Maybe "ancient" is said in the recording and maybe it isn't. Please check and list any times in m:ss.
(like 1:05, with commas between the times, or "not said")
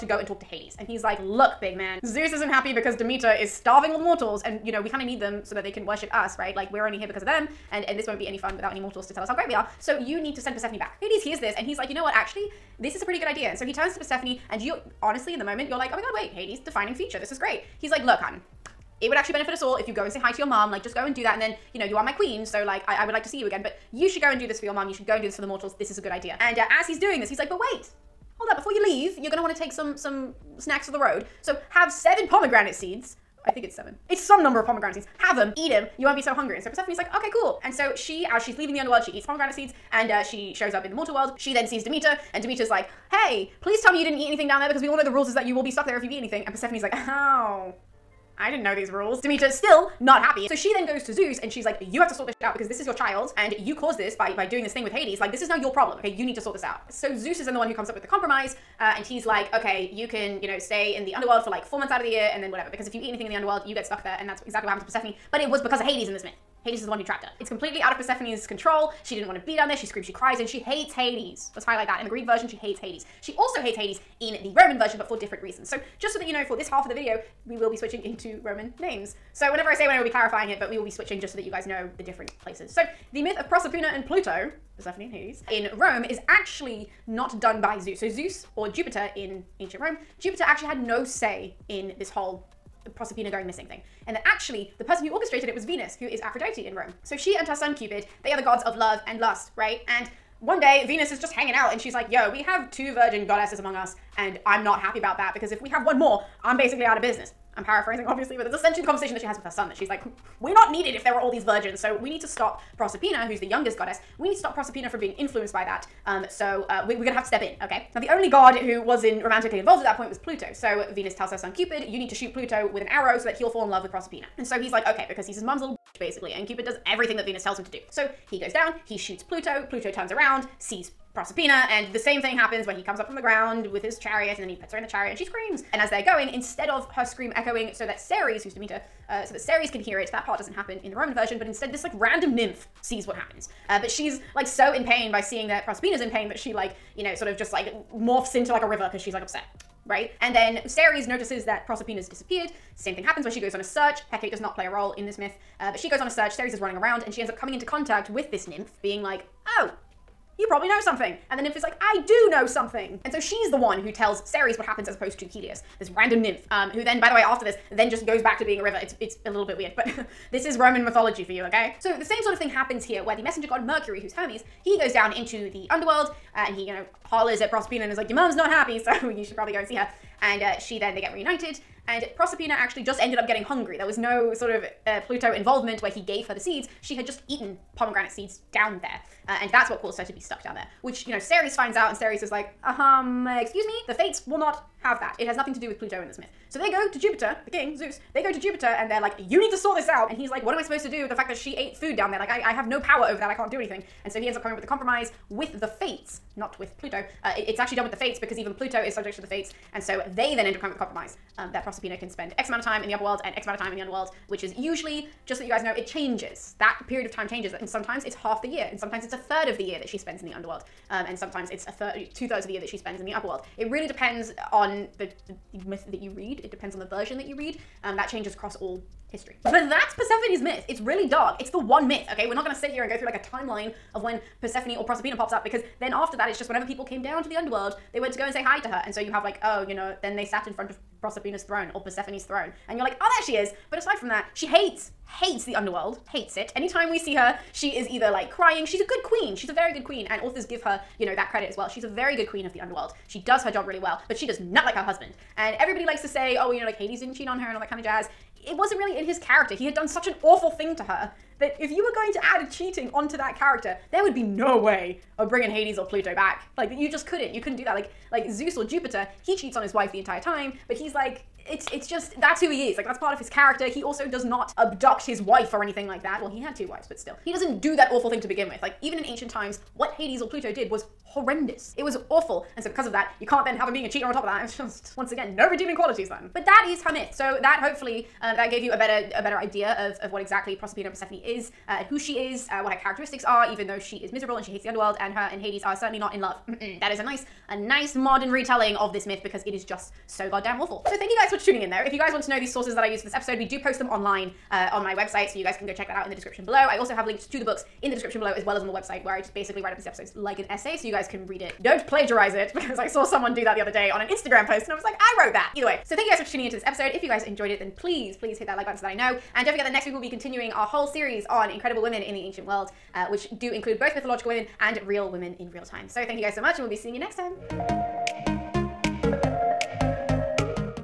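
1:29, 4:39, 5:22.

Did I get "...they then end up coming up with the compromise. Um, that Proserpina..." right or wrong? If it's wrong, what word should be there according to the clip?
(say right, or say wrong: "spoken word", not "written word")
right.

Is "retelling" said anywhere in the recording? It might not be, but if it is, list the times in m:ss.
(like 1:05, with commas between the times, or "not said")
4:58.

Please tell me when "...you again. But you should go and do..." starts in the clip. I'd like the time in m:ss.
0:23.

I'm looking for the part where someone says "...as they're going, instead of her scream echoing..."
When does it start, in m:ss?
2:15.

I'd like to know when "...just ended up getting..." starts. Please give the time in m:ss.
3:02.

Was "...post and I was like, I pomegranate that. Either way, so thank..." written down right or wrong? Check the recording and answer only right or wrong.
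wrong.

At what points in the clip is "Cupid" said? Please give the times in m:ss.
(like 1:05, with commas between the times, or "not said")
1:37, 2:01, 2:06.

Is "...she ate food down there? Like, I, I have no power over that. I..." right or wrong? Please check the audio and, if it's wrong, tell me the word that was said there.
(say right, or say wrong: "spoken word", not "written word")
right.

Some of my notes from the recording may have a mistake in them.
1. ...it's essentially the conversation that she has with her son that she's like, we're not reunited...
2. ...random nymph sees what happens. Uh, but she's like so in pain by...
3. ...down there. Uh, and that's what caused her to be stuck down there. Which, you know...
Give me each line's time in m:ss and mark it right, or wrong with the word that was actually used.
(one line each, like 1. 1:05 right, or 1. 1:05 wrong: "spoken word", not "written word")
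1. 1:48 wrong: "needed", not "reunited"
2. 2:21 right
3. 3:08 right.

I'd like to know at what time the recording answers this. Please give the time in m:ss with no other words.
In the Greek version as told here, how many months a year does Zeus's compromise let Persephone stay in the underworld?
1:01.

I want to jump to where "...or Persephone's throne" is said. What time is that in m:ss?
4:01.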